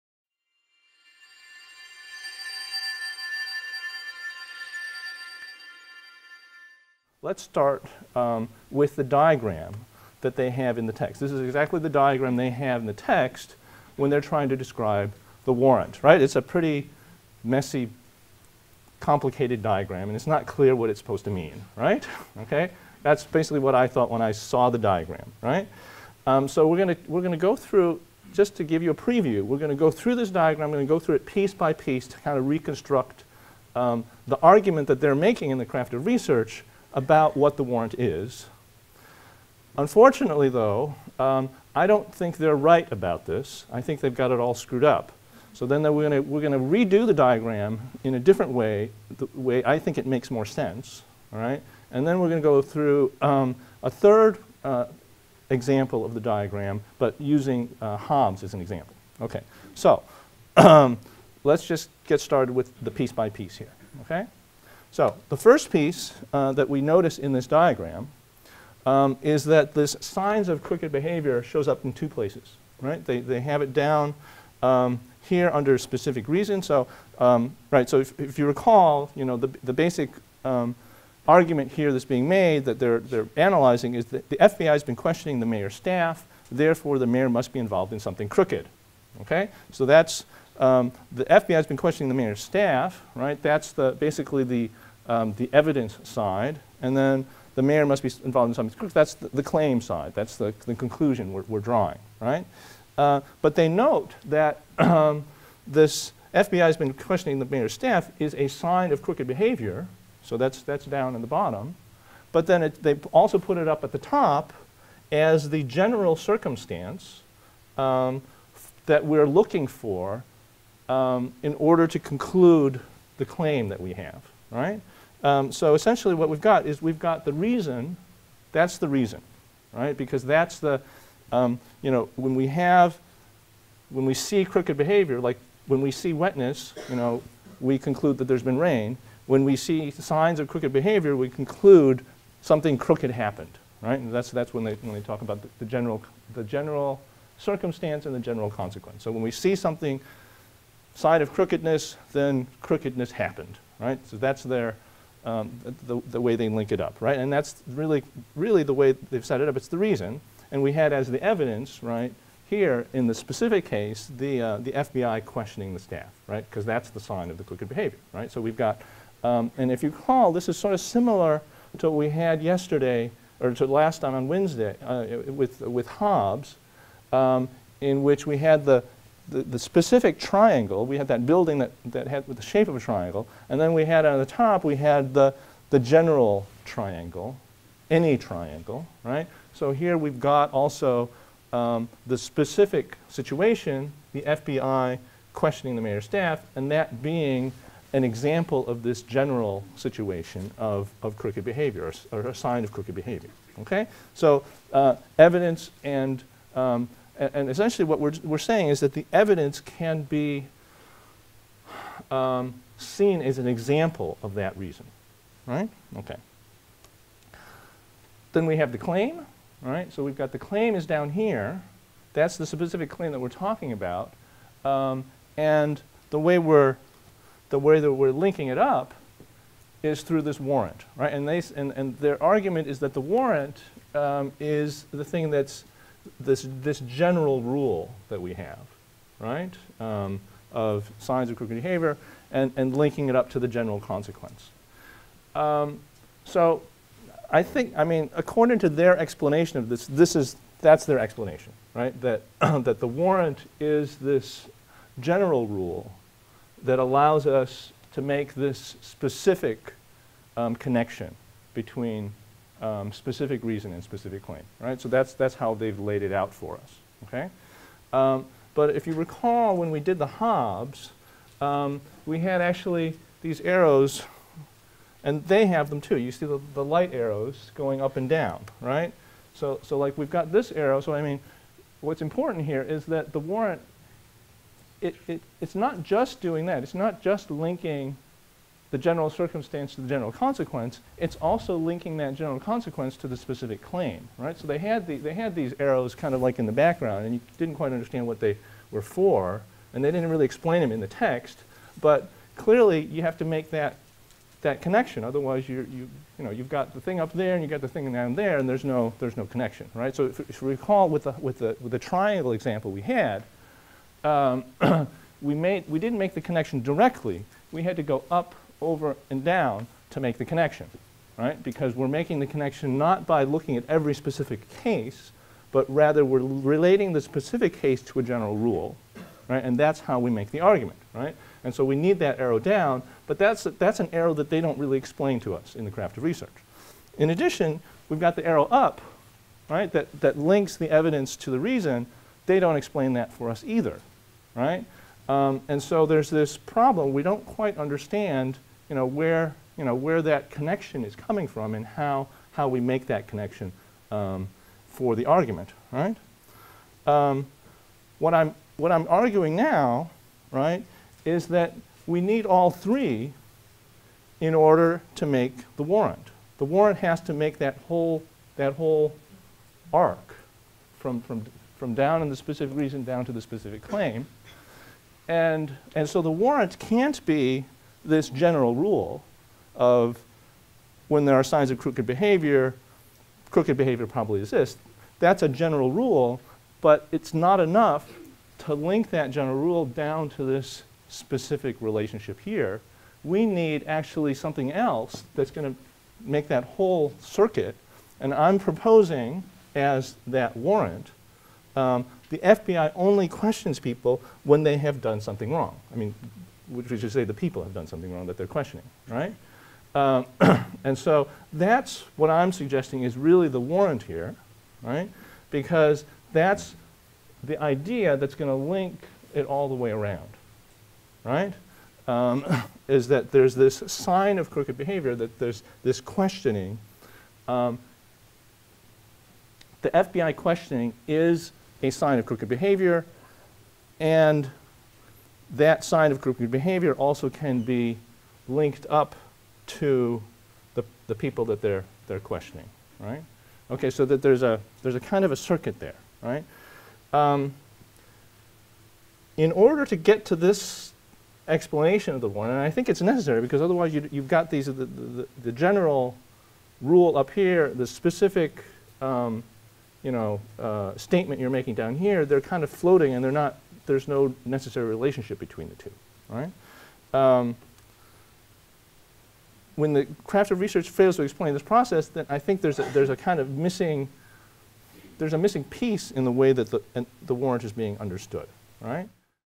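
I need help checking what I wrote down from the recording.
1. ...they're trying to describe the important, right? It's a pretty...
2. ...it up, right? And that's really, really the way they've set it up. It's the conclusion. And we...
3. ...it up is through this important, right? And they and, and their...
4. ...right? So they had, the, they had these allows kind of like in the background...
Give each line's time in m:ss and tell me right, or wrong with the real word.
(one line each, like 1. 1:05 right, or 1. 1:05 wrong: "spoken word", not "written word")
1. 0:14 wrong: "warrant", not "important"
2. 2:36 wrong: "reason", not "conclusion"
3. 3:48 wrong: "warrant", not "important"
4. 4:54 wrong: "arrows", not "allows".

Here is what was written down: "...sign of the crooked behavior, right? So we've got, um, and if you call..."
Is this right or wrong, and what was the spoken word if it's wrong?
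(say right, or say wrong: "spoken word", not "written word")
right.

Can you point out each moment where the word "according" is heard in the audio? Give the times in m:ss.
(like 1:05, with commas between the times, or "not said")
4:08.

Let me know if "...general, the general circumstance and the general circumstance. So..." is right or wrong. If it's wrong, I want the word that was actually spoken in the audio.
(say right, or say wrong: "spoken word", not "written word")
wrong: "consequence", not "circumstance".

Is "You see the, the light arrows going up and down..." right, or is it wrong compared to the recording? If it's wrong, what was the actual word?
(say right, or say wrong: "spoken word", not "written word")
right.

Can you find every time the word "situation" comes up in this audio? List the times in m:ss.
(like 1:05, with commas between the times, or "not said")
3:13, 3:19.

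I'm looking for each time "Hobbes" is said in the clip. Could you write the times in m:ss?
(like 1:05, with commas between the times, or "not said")
0:57, 2:55, 4:30.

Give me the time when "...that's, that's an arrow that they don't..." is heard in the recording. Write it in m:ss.
5:33.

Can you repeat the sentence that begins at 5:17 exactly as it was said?
We had to go up over and down to make the connection, right?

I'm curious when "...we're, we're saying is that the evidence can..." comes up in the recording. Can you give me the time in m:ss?
3:27.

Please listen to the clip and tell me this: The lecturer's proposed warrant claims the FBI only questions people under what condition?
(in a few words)
when they have done something wrong.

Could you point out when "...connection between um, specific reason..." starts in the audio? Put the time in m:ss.
4:20.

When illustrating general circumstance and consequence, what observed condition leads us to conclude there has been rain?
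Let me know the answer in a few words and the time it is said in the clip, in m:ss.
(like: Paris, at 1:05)
wetness, at 2:16.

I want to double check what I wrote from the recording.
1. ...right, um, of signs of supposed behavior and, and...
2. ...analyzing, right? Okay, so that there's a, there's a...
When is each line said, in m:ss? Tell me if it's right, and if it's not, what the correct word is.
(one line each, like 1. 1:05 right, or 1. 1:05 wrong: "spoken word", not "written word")
1. 3:59 wrong: "crooked", not "supposed"
2. 7:21 wrong: "questioning", not "analyzing".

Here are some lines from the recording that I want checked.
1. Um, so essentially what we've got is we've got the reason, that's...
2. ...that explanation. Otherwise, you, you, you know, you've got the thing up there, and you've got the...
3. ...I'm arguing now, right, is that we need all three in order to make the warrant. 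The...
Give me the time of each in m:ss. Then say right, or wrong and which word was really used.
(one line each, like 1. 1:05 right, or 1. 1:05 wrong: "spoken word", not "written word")
1. 2:05 right
2. 5:04 wrong: "connection", not "explanation"
3. 5:58 right.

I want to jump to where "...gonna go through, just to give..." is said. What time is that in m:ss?
0:27.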